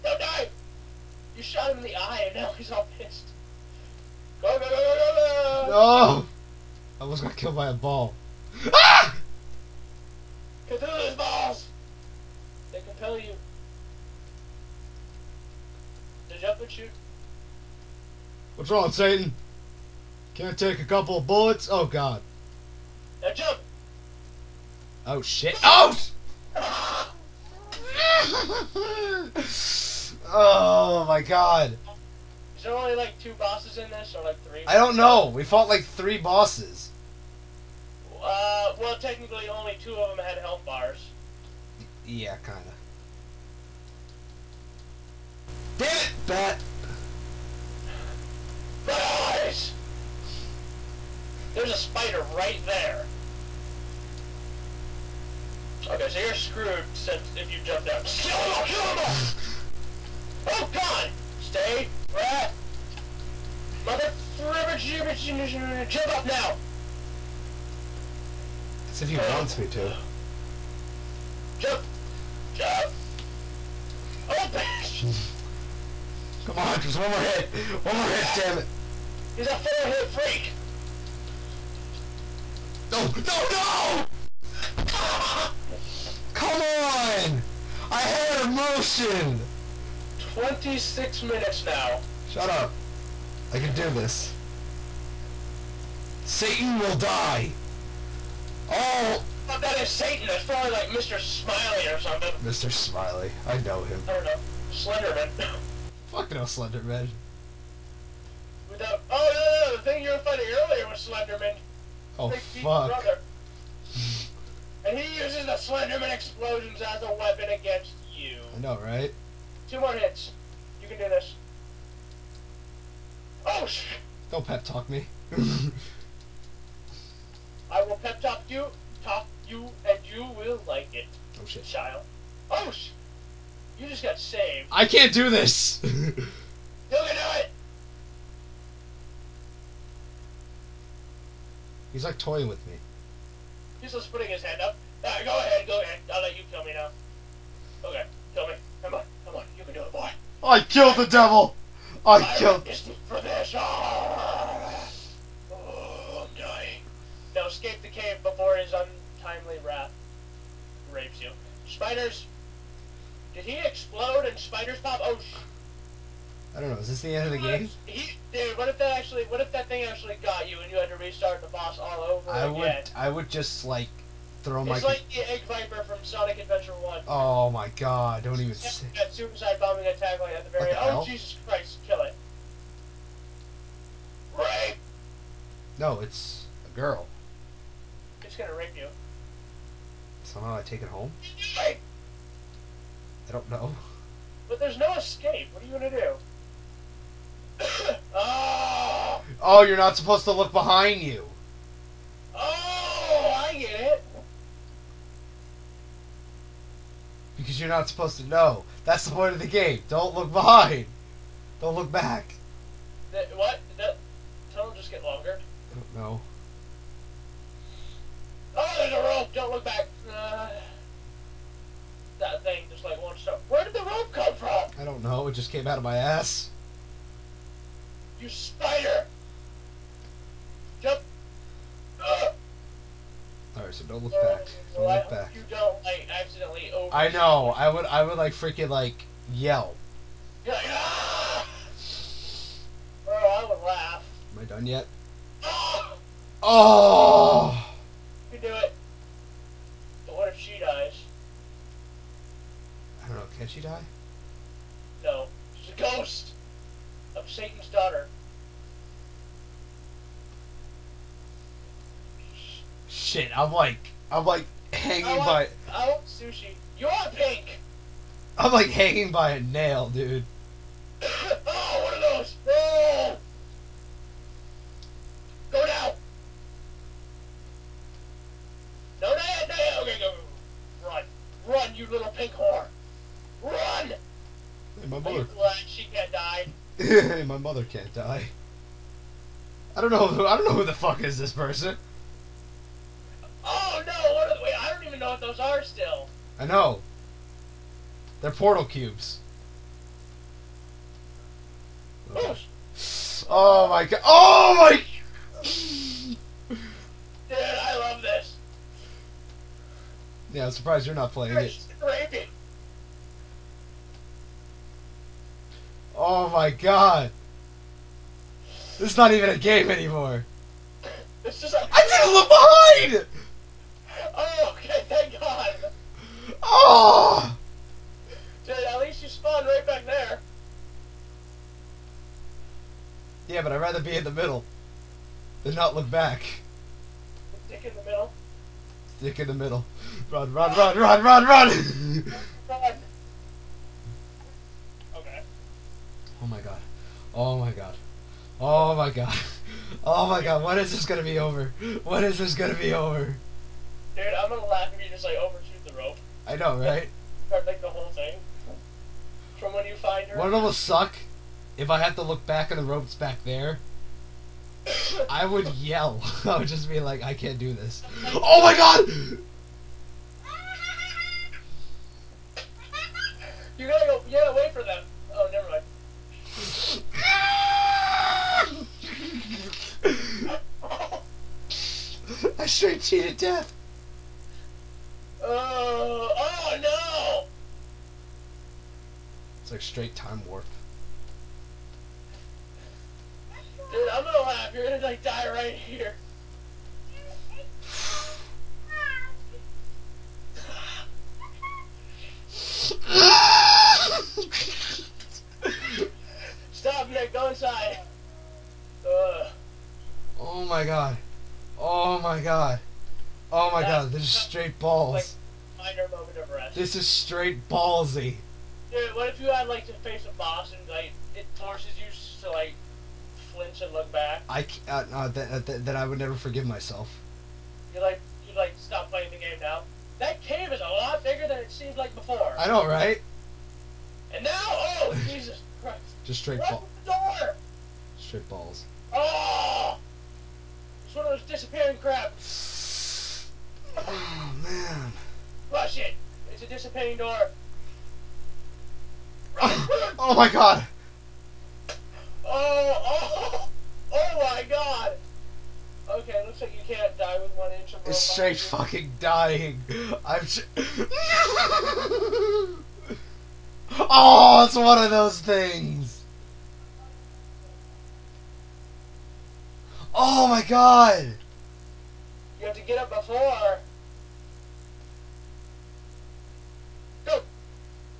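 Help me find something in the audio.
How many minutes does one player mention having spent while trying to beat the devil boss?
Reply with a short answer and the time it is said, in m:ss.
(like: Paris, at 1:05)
26, at 1:30.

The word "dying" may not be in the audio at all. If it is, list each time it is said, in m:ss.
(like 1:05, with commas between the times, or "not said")
2:36, 7:39.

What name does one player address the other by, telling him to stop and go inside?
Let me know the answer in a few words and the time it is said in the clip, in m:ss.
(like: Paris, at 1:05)
Nick, at 6:46.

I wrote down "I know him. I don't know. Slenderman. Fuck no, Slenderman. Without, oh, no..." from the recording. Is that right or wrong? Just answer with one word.
right.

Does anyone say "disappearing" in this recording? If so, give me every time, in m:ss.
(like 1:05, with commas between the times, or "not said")
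7:21, 7:26.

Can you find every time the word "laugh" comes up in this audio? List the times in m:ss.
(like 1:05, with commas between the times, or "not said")
4:03, 5:54, 6:34.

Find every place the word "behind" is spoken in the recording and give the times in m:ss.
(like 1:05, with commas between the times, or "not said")
3:20, 3:30, 5:23.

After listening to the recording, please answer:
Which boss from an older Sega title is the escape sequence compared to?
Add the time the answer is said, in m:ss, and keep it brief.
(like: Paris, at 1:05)
Egg Viper, at 2:55.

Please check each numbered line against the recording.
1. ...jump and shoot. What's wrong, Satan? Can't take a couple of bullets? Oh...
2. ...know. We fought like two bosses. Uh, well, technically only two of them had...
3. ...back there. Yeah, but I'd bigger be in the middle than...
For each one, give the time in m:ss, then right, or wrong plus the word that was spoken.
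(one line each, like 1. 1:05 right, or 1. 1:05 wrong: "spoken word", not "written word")
1. 0:16 right
2. 0:34 wrong: "three", not "two"
3. 5:29 wrong: "rather", not "bigger".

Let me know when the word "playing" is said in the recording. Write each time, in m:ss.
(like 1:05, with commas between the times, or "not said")
5:11, 7:08.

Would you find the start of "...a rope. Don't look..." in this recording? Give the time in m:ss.
3:38.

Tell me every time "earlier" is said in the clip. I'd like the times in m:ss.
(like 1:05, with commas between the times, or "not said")
1:50.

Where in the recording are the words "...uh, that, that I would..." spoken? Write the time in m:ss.
7:05.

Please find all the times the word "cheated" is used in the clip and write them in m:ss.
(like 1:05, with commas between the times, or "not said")
6:22.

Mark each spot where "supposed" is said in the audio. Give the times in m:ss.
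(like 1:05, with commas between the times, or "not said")
3:19, 3:27.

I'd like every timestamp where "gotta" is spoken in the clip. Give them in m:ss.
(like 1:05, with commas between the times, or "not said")
6:13.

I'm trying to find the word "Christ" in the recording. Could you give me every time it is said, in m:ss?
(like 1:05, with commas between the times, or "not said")
3:01, 7:15.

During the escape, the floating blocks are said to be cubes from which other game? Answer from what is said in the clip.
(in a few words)
Portal.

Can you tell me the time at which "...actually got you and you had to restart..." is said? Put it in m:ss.
2:49.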